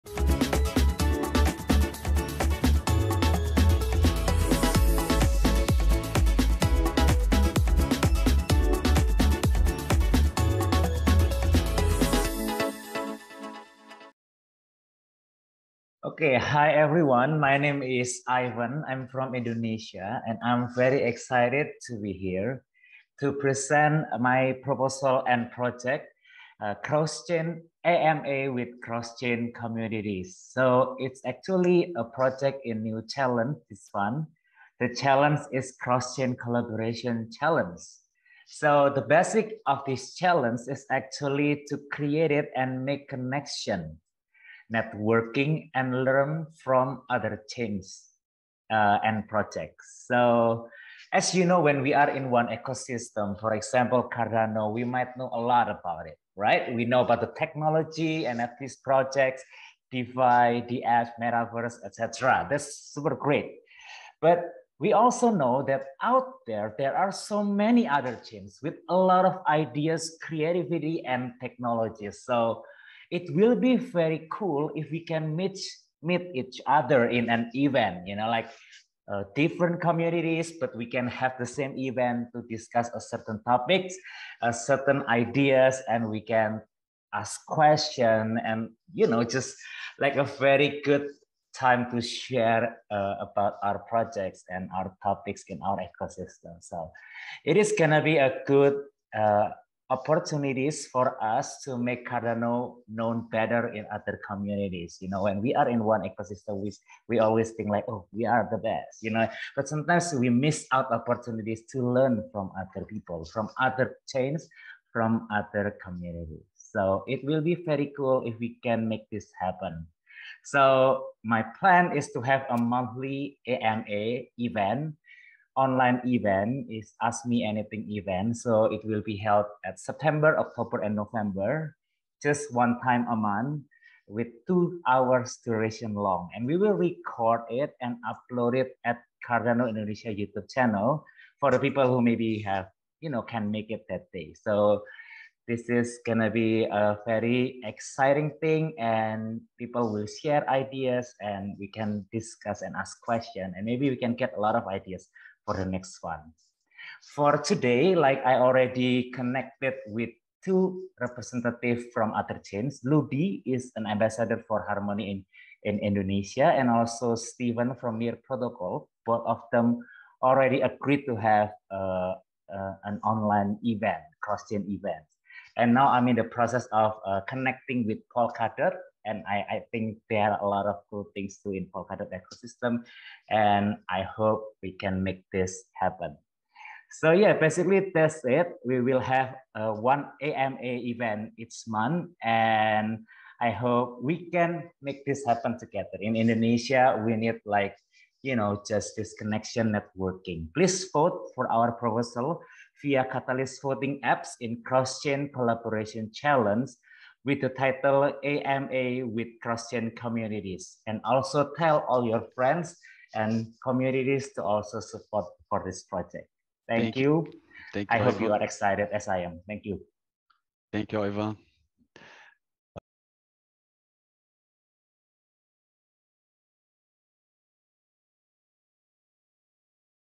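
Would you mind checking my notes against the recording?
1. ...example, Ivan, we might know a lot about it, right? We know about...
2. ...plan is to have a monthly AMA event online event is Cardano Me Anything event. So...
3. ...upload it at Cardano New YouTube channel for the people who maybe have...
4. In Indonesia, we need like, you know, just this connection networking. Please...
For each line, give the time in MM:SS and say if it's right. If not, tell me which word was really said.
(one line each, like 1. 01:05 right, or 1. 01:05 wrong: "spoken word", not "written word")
1. 00:53 wrong: "Cardano", not "Ivan"
2. 02:01 wrong: "Ask", not "Cardano"
3. 02:18 wrong: "Indonesia", not "New"
4. 03:16 right.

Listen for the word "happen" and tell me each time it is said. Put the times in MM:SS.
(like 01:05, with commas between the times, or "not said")
01:59, 03:05, 03:15.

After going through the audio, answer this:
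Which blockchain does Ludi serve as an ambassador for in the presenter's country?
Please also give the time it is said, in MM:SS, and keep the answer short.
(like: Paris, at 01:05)
Harmony, at 02:44.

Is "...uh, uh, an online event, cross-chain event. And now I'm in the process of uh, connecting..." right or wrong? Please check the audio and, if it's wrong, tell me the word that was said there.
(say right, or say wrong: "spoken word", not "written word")
right.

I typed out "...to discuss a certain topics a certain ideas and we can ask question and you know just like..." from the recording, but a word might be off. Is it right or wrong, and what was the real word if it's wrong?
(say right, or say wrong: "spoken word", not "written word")
right.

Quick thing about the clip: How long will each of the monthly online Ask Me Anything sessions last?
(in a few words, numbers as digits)
2 hours.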